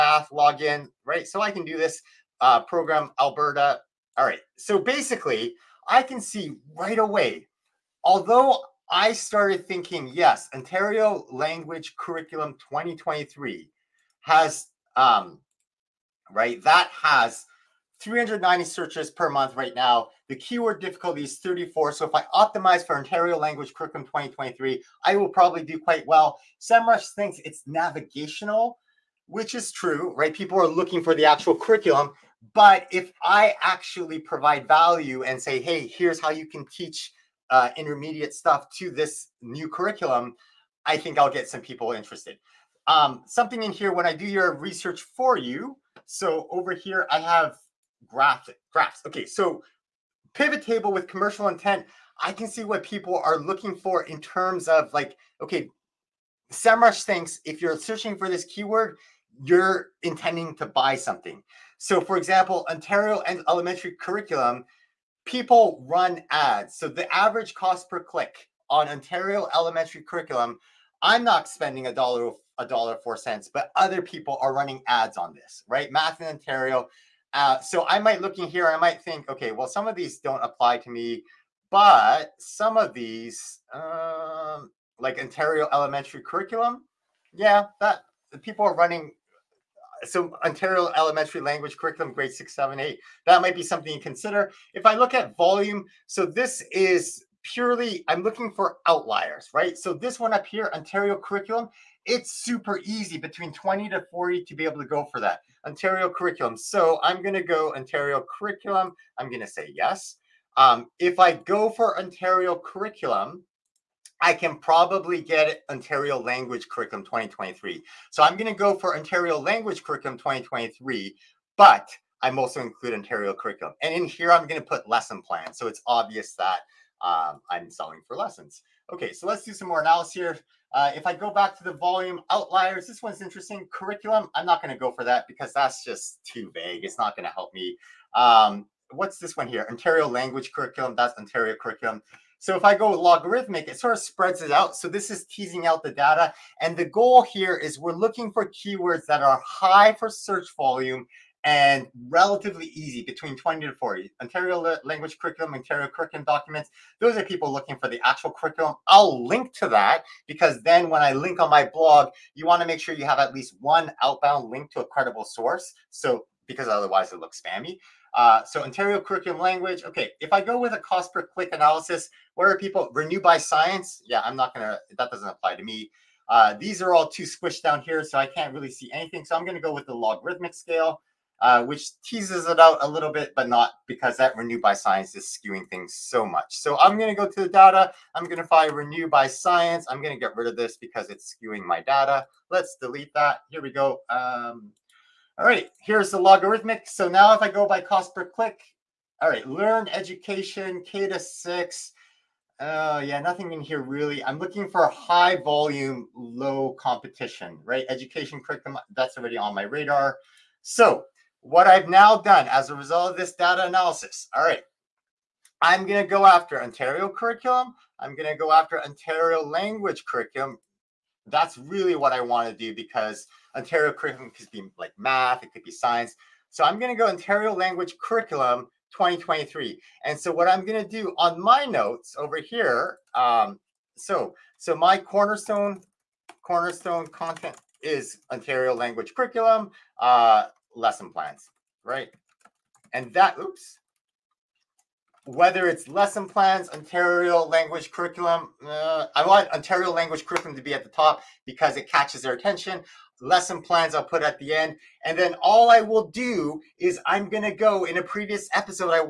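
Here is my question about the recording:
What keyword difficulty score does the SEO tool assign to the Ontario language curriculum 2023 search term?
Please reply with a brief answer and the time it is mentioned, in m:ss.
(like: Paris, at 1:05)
34, at 0:21.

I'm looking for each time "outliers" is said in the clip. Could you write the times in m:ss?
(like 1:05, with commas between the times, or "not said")
1:38, 2:12.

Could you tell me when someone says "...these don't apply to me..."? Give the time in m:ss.
1:19.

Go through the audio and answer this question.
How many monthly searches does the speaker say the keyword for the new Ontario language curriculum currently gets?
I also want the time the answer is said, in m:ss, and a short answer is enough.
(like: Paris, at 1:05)
390, at 0:17.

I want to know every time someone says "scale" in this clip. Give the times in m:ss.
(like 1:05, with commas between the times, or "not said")
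3:00.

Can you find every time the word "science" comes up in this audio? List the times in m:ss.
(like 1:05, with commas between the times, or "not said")
2:53, 3:04, 3:09, 3:45.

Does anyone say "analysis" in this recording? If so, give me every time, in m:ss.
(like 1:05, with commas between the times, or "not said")
2:09, 2:51, 3:33.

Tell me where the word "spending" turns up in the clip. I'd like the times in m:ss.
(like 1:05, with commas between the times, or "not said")
1:11.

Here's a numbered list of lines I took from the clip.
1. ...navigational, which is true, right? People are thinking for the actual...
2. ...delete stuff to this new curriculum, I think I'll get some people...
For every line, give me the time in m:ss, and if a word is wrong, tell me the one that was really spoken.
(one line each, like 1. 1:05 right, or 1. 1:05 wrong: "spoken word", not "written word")
1. 0:27 wrong: "looking", not "thinking"
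2. 0:37 wrong: "intermediate", not "delete".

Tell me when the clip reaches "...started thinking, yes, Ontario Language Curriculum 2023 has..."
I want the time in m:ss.
0:09.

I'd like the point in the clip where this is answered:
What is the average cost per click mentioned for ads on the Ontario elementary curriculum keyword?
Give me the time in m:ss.
1:12.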